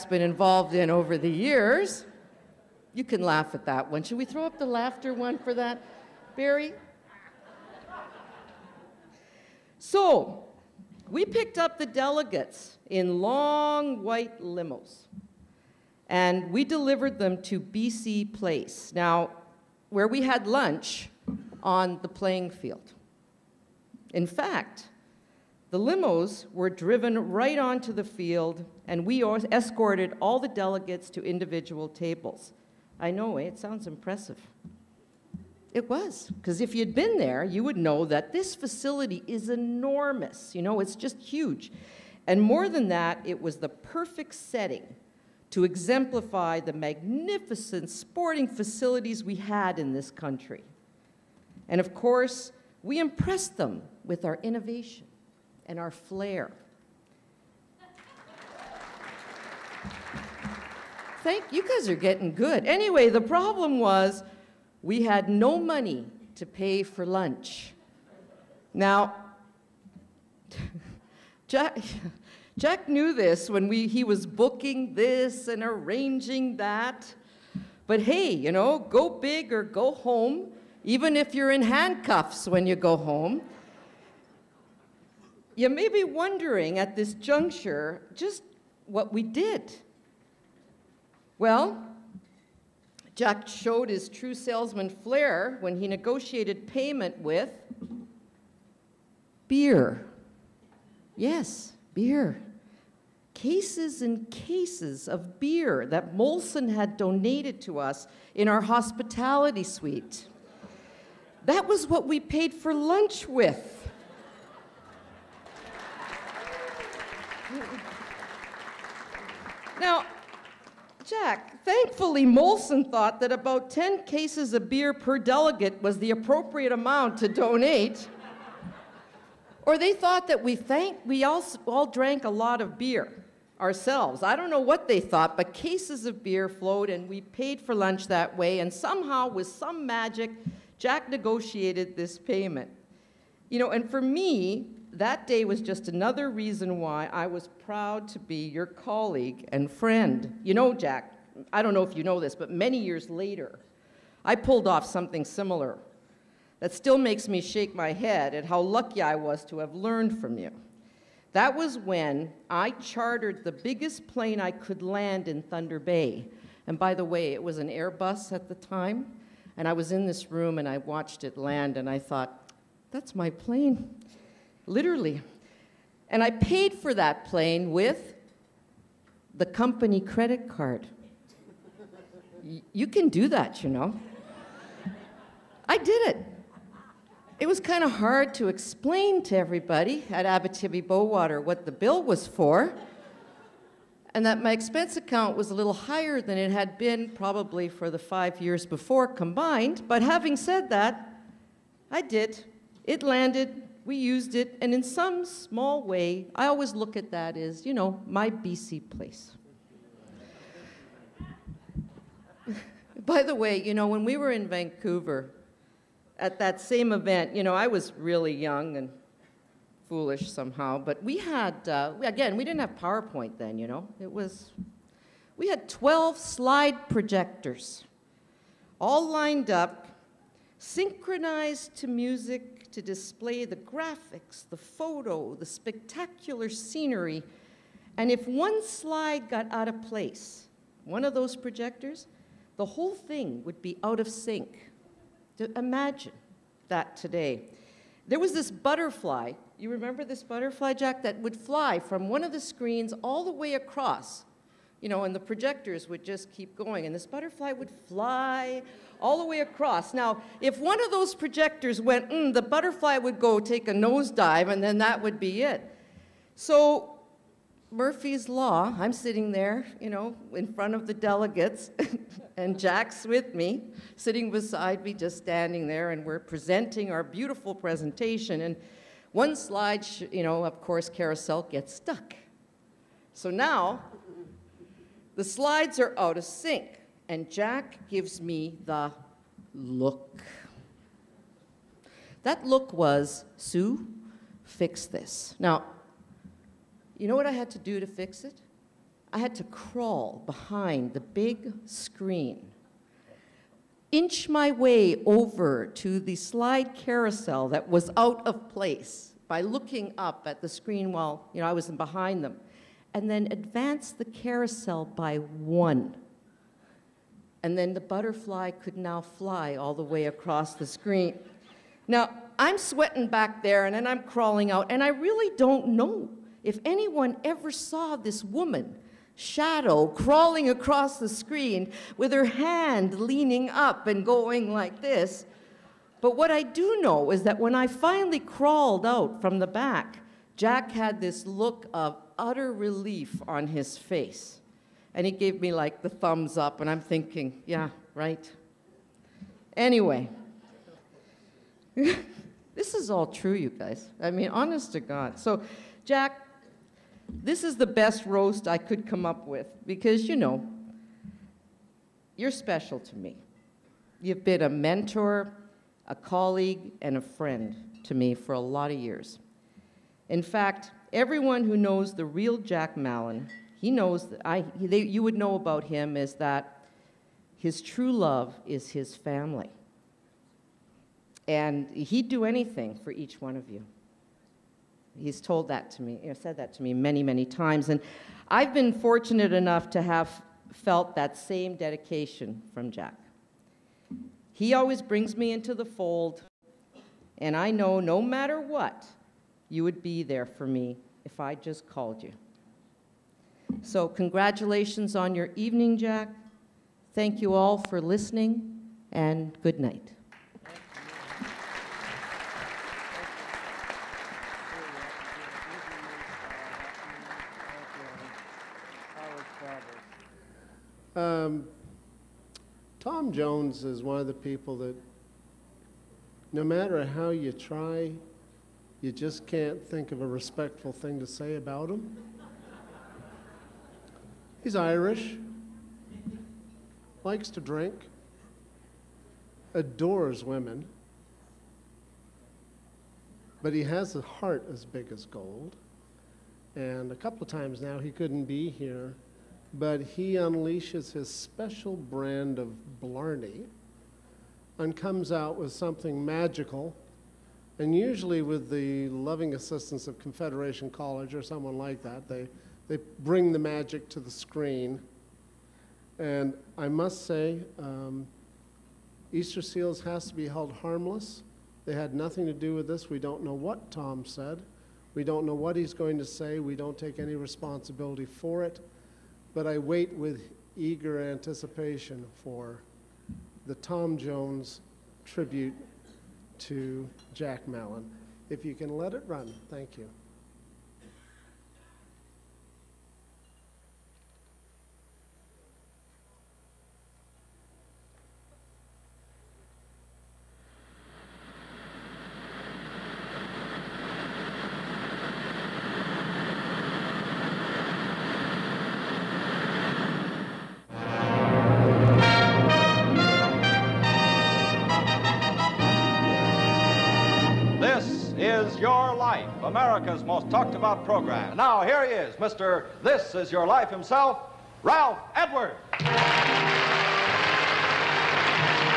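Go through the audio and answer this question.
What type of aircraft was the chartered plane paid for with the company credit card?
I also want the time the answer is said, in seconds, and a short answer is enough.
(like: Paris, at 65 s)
Airbus, at 167 s.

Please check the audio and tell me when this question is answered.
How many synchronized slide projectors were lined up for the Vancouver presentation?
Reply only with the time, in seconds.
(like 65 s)
225 s.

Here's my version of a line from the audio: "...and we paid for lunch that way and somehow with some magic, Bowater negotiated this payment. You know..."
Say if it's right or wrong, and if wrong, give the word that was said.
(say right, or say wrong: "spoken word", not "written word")
wrong: "Jack", not "Bowater".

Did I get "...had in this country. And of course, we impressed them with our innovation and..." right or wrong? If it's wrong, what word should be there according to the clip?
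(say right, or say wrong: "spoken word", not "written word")
right.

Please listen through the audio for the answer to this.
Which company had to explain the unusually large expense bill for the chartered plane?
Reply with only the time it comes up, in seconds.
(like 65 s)
190 s.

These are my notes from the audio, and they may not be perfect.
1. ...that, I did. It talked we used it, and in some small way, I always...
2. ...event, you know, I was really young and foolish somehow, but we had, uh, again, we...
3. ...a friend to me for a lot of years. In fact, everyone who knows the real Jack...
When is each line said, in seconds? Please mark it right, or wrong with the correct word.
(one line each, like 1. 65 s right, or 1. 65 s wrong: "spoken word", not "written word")
1. 200 s wrong: "landed", not "talked"
2. 216 s right
3. 366 s right.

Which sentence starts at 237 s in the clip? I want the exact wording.
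And if one slide got out of place, one of those projectors, the whole thing would be out of sync.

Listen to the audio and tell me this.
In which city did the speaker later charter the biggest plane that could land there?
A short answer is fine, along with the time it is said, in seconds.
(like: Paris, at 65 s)
Thunder Bay, at 165 s.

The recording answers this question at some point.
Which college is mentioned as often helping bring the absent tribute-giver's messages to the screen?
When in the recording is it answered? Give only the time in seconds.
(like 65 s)
459 s.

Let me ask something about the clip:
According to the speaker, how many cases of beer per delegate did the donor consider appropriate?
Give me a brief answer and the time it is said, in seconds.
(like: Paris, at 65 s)
10, at 123 s.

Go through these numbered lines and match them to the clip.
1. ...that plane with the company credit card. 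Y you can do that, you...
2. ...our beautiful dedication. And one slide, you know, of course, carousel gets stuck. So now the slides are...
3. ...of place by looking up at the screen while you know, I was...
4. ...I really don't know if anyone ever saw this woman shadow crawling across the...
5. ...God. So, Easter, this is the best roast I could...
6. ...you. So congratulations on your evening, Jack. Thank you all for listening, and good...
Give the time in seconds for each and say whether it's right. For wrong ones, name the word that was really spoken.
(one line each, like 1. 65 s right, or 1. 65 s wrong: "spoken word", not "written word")
1. 176 s right
2. 276 s wrong: "presentation", not "dedication"
3. 308 s right
4. 324 s right
5. 354 s wrong: "Jack", not "Easter"
6. 402 s right.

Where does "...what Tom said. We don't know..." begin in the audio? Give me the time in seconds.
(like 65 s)
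473 s.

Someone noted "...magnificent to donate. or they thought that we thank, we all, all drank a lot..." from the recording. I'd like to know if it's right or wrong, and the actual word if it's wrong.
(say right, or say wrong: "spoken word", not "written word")
wrong: "amount", not "magnificent".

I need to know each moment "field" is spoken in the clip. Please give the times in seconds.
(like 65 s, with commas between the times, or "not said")
22 s, 28 s.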